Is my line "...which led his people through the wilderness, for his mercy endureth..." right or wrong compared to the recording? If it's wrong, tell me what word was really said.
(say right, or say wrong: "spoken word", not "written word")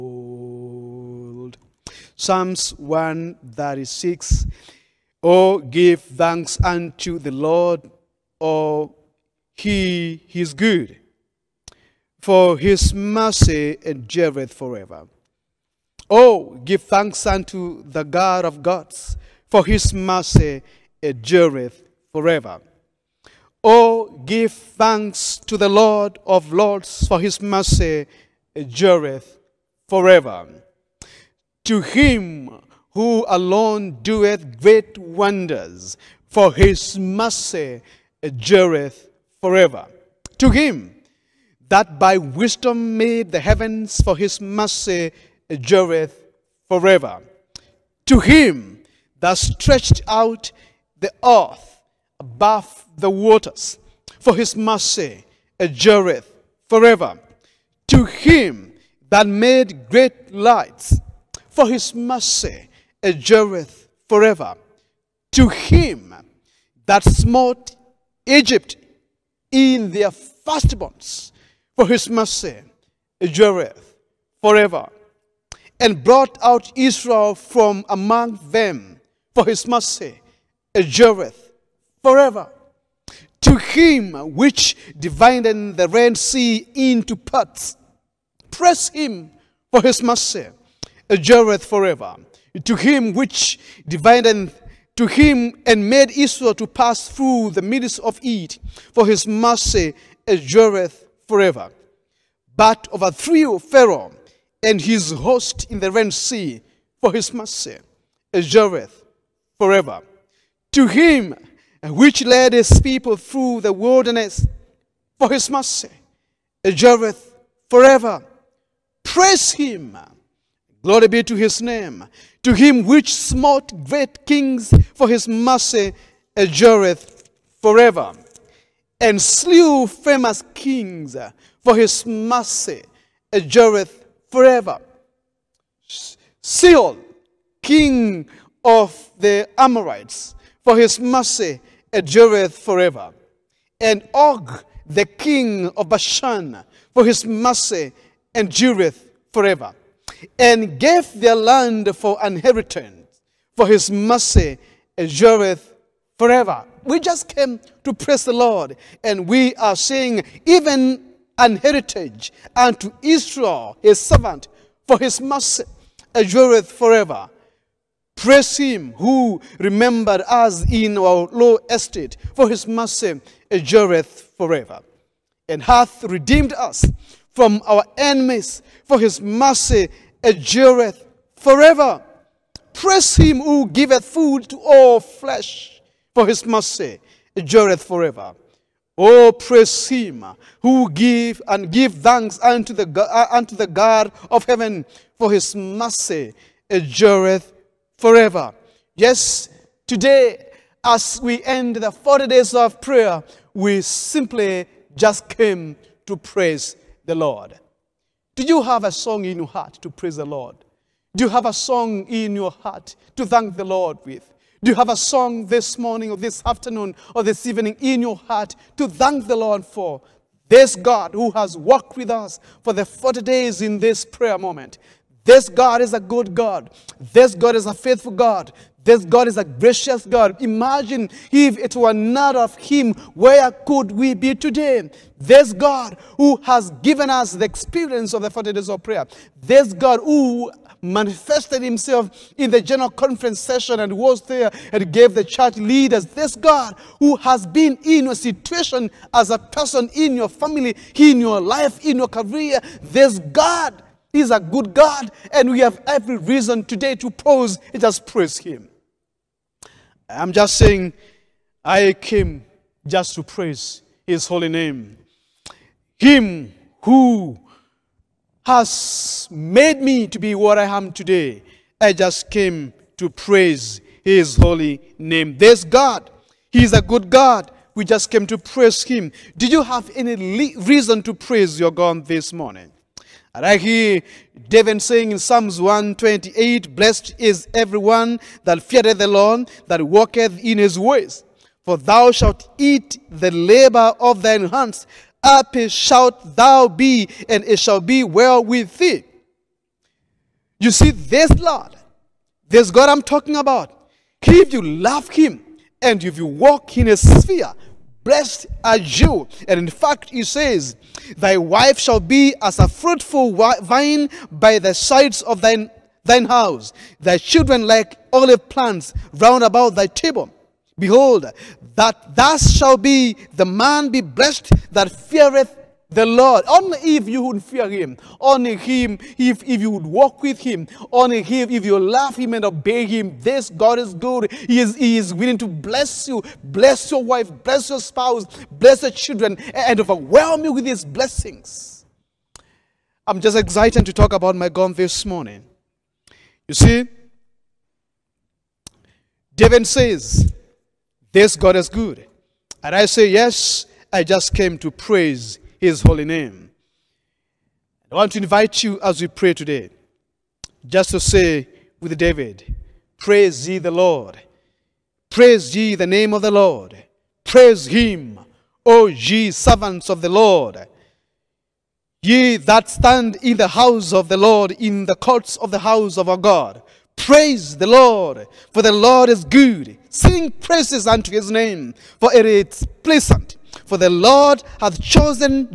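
right.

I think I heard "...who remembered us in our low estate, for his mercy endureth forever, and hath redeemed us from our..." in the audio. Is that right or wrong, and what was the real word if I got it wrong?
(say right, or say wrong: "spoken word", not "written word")
right.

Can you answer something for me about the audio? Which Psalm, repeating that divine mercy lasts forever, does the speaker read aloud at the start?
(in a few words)
Psalms 136.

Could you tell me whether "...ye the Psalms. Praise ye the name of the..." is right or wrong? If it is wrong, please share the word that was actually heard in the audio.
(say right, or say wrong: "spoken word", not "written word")
wrong: "Lord", not "Psalms".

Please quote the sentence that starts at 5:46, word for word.
You see, David says, This God is good.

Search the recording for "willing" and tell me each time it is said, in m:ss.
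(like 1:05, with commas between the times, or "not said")
5:35.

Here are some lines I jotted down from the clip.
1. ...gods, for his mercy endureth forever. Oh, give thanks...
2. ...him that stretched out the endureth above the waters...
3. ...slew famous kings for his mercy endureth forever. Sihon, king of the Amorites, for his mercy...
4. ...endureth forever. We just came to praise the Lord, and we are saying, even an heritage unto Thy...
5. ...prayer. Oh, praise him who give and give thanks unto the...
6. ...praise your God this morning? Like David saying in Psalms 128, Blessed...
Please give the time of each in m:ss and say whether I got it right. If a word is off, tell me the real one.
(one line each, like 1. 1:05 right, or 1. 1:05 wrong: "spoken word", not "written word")
1. 0:18 right
2. 0:48 wrong: "earth", not "endureth"
3. 2:09 right
4. 2:34 wrong: "Israel", not "Thy"
5. 3:07 wrong: "forever", not "prayer"
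6. 4:41 right.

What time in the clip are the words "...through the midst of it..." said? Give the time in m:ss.
1:37.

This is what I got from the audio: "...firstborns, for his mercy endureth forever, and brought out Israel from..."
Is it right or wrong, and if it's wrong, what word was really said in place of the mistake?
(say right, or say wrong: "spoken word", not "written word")
right.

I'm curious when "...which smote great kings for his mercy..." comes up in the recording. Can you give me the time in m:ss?
2:02.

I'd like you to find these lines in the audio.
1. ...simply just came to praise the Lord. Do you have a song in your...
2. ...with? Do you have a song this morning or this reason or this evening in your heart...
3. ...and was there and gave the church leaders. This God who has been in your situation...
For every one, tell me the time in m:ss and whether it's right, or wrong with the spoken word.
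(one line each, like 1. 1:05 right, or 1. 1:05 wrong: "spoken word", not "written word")
1. 3:23 right
2. 3:34 wrong: "afternoon", not "reason"
3. 4:03 right.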